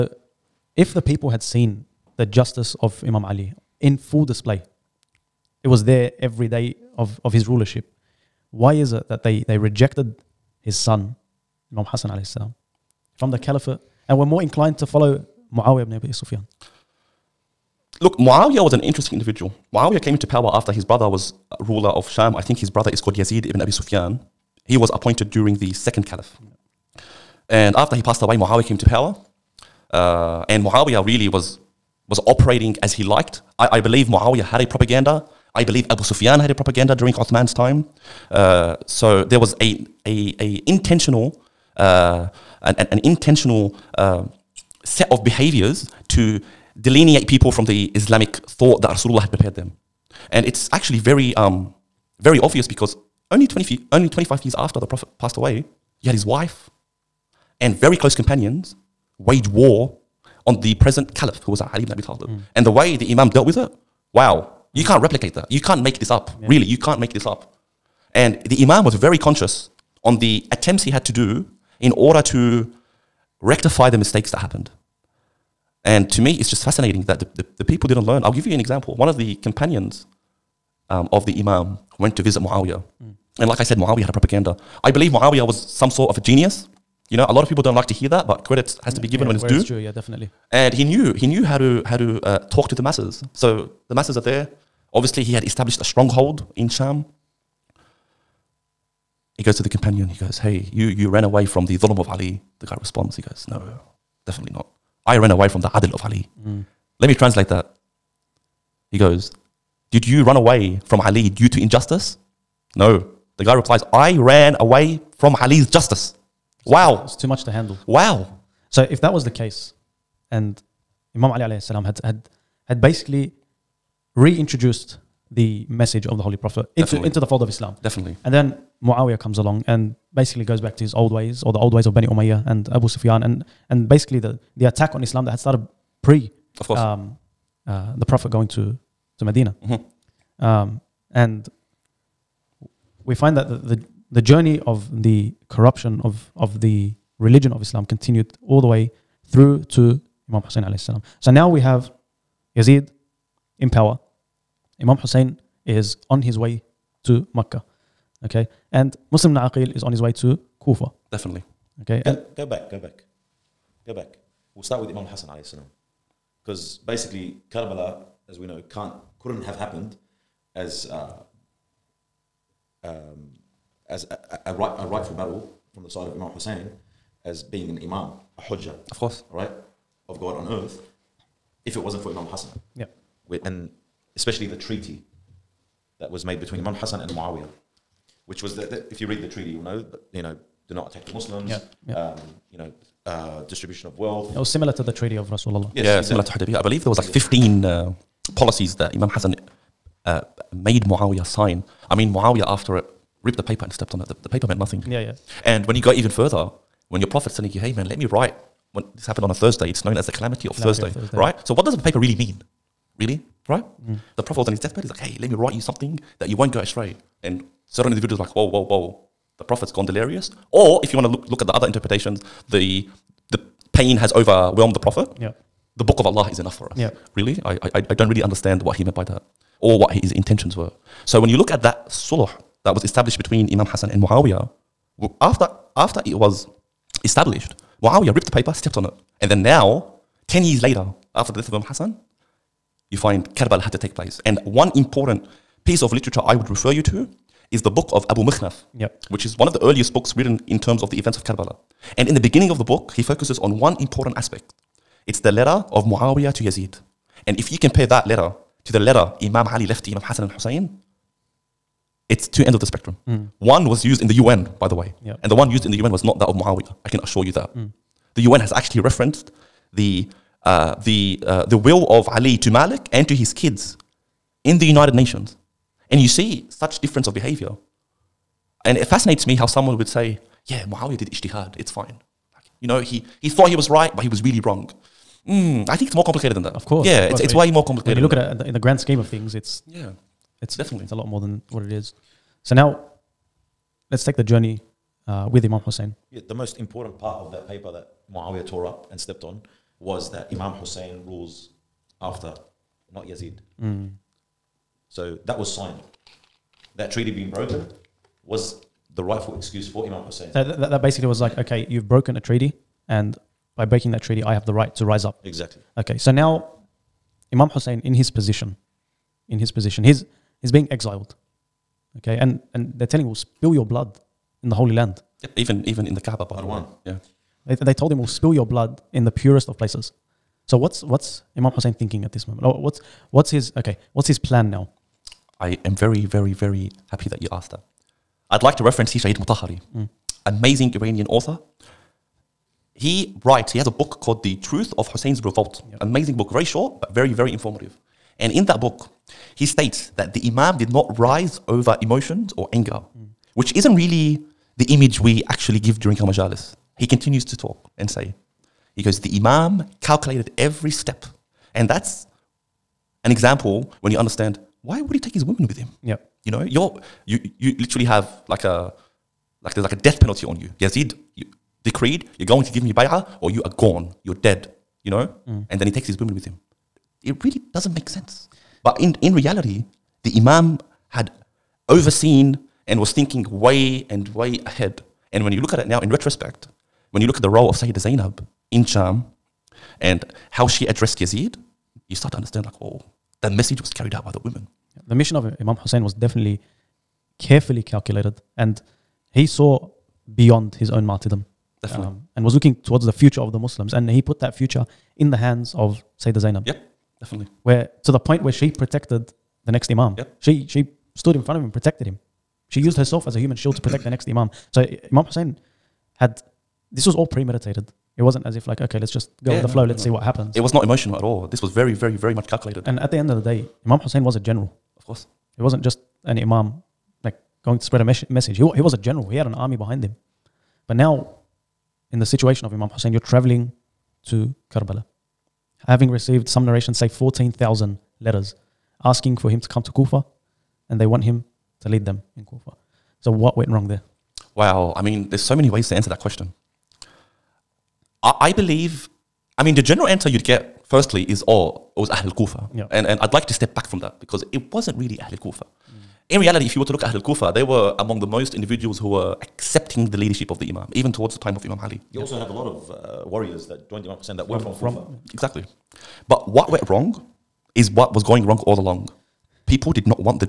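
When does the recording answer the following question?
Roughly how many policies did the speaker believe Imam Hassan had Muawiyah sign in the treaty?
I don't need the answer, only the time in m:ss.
3:17.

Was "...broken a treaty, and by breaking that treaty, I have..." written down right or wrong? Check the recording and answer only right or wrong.
right.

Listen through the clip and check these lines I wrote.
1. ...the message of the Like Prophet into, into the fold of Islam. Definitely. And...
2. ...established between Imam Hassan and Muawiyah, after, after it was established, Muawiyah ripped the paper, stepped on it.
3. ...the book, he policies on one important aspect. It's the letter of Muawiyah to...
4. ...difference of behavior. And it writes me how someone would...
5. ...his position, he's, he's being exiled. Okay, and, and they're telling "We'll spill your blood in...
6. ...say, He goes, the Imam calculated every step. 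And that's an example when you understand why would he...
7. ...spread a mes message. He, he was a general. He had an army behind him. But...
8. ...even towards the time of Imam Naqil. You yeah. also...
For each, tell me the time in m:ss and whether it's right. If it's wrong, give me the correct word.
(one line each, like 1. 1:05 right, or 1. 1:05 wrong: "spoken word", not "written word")
1. 2:05 wrong: "Holy", not "Like"
2. 3:52 right
3. 4:12 wrong: "focuses", not "policies"
4. 4:36 wrong: "fascinates", not "writes"
5. 5:19 right
6. 5:57 right
7. 7:07 right
8. 7:40 wrong: "Ali", not "Naqil".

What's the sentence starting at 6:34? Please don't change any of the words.
The mission of Imam Hussein was definitely carefully calculated and he saw beyond his own martyrdom.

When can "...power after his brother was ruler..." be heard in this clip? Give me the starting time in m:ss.
0:20.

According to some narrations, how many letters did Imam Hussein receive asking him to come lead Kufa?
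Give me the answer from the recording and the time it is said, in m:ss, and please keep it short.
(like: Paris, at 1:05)
14,000, at 7:16.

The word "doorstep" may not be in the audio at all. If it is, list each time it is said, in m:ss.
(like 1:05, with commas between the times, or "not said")
not said.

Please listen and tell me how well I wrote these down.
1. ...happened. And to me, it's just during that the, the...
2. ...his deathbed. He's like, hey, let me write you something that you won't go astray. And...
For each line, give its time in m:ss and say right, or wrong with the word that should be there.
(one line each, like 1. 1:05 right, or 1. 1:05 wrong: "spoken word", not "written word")
1. 1:14 wrong: "fascinating", not "during"
2. 3:34 right.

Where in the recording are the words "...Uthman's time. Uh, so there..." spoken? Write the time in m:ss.
0:37.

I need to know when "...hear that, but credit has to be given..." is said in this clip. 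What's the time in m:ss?
1:27.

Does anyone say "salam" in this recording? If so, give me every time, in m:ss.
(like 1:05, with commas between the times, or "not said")
0:12, 2:01, 2:30, 2:45.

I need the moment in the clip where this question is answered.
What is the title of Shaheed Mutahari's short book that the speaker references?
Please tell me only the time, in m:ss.
5:44.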